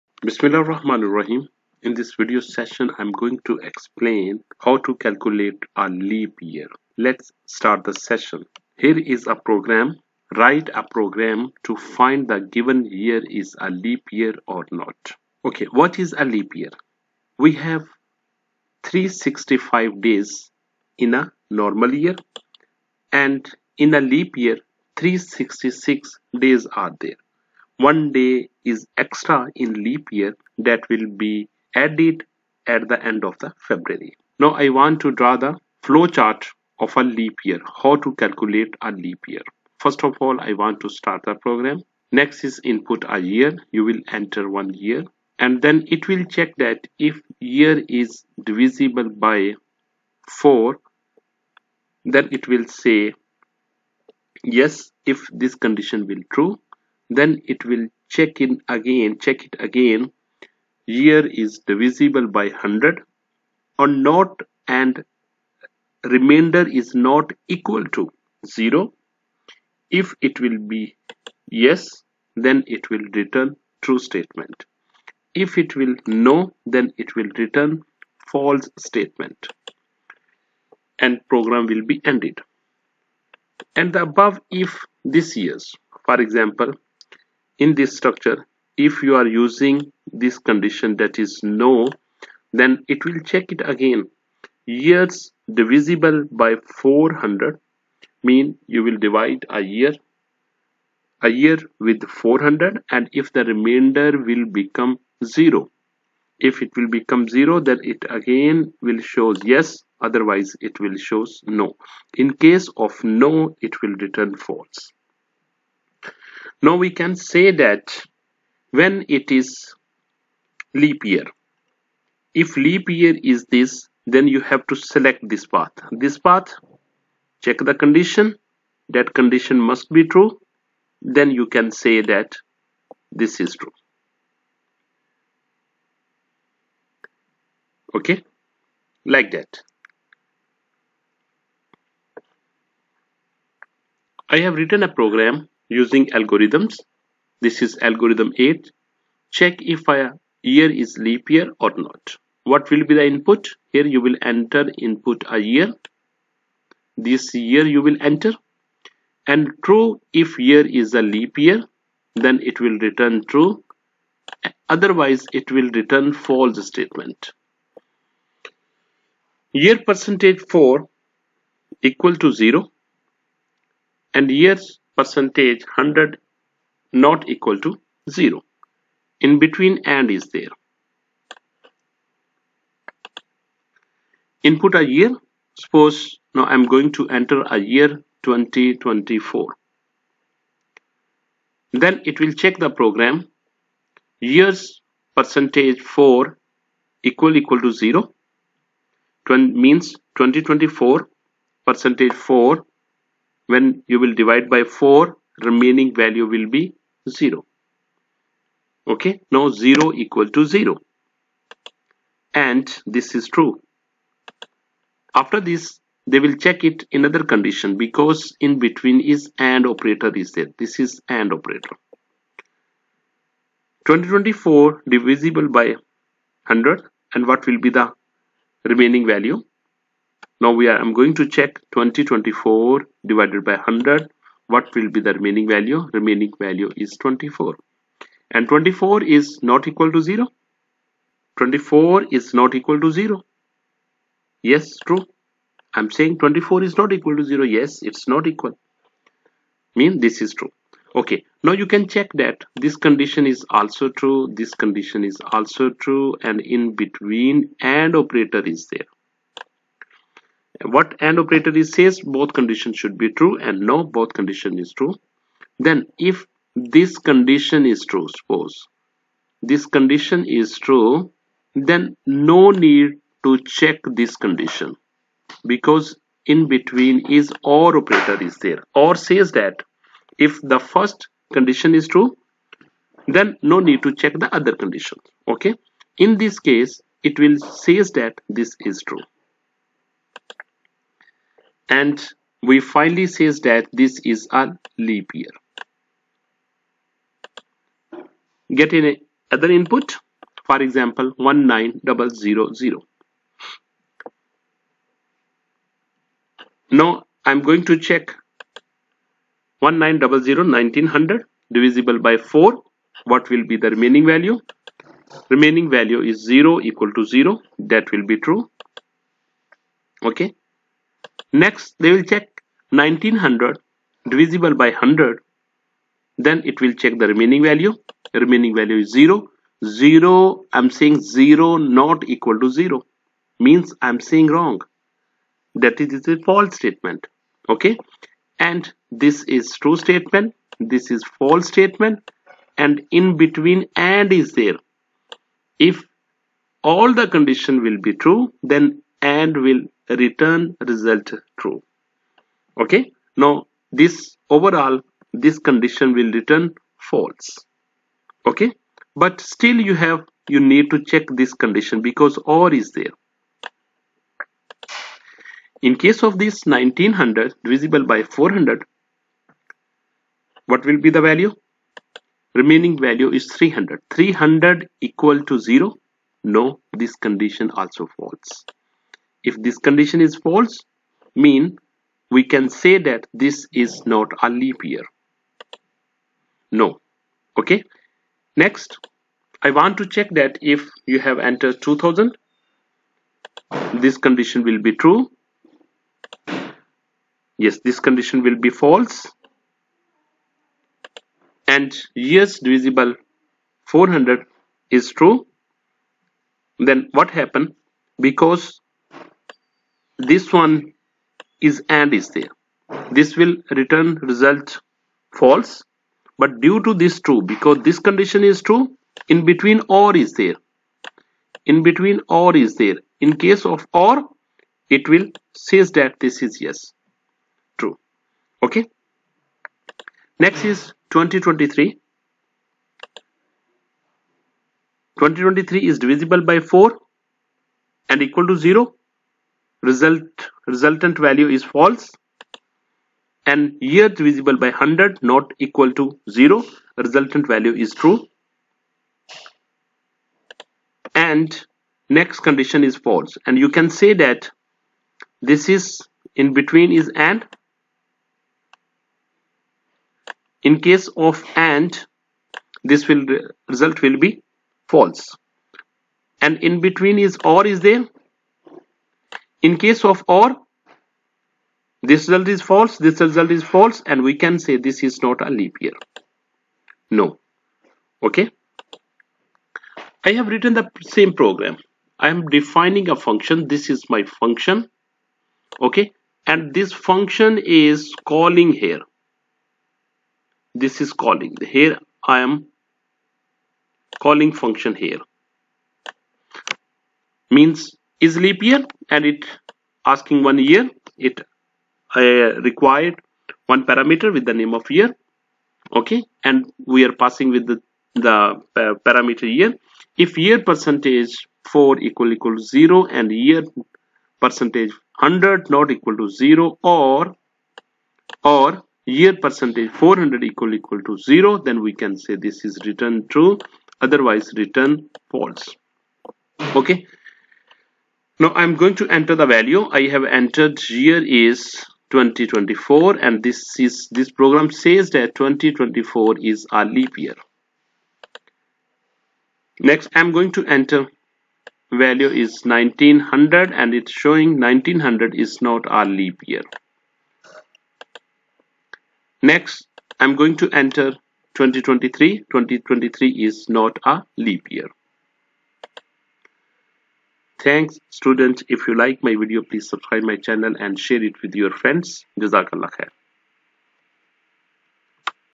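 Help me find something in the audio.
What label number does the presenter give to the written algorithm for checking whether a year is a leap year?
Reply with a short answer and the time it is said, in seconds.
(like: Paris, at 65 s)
8, at 147 s.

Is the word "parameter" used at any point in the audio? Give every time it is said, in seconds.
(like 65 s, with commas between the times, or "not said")
503 s, 508 s.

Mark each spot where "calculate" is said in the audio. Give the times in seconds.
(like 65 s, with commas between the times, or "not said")
4 s, 38 s.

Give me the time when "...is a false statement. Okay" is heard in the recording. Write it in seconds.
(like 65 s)
335 s.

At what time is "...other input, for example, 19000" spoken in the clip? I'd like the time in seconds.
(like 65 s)
299 s.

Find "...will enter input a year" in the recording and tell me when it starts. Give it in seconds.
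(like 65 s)
154 s.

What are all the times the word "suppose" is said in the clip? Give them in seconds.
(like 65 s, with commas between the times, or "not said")
185 s, 268 s.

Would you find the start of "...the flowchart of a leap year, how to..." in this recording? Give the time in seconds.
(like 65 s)
35 s.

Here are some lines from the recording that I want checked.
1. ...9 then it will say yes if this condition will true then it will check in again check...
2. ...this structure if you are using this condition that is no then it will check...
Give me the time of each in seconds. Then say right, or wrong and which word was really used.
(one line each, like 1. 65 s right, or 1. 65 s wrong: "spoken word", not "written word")
1. 50 s wrong: "4", not "9"
2. 87 s right.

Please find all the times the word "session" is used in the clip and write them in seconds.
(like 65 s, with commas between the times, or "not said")
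2 s, 7 s.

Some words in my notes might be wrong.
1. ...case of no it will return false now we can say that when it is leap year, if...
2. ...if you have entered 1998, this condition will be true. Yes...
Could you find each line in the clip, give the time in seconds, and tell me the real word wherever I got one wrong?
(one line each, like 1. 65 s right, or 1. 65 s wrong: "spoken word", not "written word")
1. 112 s right
2. 390 s wrong: "2000", not "1998".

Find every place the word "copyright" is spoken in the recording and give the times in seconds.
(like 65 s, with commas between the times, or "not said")
not said.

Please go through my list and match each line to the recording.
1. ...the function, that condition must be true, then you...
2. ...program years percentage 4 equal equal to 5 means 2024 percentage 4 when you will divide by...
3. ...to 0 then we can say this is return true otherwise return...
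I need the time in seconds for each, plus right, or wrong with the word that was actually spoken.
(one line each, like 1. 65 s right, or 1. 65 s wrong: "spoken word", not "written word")
1. 127 s wrong: "condition", not "function"
2. 192 s wrong: "0", not "5"
3. 520 s right.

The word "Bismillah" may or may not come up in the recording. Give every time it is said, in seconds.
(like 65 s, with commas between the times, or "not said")
0 s.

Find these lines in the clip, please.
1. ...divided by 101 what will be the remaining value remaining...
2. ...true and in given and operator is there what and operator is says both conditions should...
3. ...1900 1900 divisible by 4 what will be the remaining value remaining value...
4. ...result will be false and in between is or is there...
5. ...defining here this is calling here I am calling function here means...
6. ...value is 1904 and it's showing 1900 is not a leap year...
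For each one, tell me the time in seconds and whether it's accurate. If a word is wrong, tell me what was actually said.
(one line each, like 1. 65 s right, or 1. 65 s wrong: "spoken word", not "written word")
1. 233 s wrong: "100", not "101"
2. 255 s wrong: "between", not "given"
3. 309 s right
4. 463 s right
5. 488 s wrong: "calling", not "defining"
6. 541 s wrong: "1900", not "1904".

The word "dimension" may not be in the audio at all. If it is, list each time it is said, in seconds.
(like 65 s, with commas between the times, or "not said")
not said.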